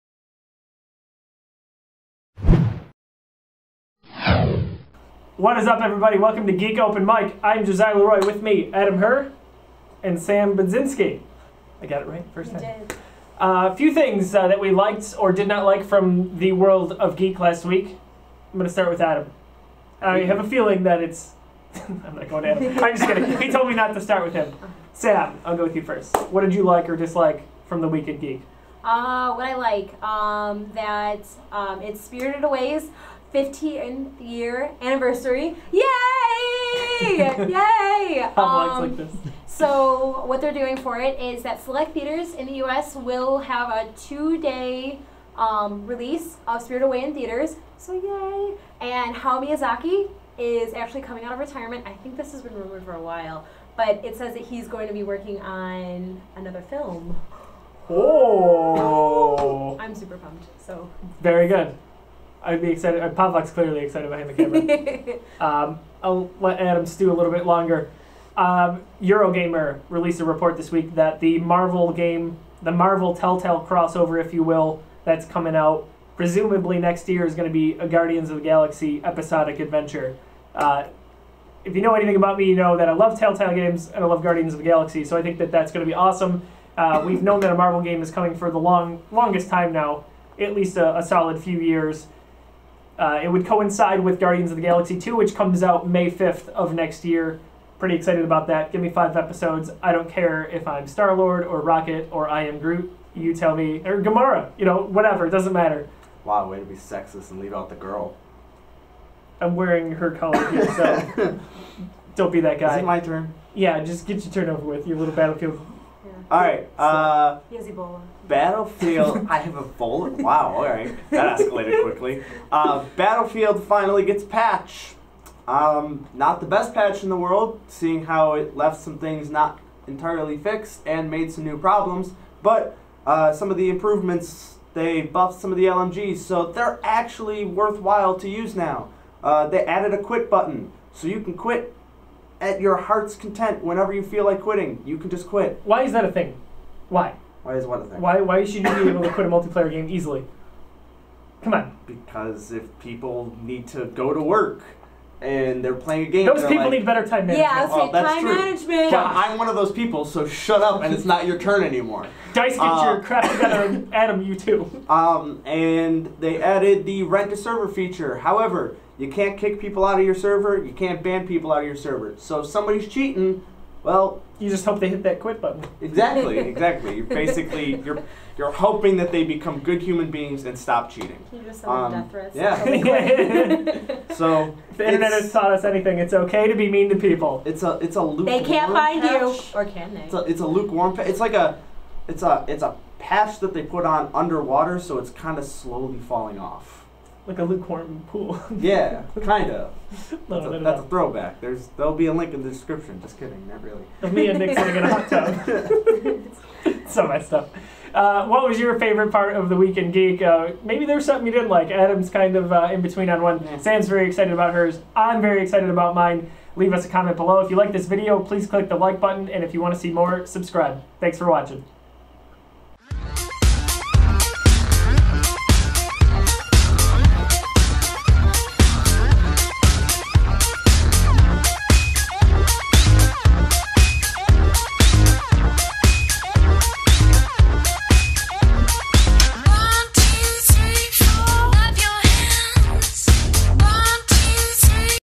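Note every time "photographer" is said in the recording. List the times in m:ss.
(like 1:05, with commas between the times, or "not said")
not said.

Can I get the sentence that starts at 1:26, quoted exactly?
Uh, we've known that a Marvel game is coming for the long longest time now, at least a, a solid few years.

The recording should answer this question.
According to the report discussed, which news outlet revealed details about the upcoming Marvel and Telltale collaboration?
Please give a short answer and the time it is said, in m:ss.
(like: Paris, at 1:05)
Eurogamer, at 1:09.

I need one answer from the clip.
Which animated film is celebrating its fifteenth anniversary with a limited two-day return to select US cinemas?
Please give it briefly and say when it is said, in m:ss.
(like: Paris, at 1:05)
Spirited Away, at 0:32.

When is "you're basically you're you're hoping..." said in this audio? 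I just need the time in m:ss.
2:56.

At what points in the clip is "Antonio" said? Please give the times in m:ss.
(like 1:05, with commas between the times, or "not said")
not said.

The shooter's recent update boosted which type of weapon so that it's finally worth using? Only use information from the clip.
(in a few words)
LMGs.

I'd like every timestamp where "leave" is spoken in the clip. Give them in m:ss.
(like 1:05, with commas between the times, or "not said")
1:47, 3:36.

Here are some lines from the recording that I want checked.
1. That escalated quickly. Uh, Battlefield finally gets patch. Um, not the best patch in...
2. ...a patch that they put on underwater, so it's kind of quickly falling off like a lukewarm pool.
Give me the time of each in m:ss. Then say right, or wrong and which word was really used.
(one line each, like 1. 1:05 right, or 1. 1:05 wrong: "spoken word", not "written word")
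1. 2:01 right
2. 3:12 wrong: "slowly", not "quickly".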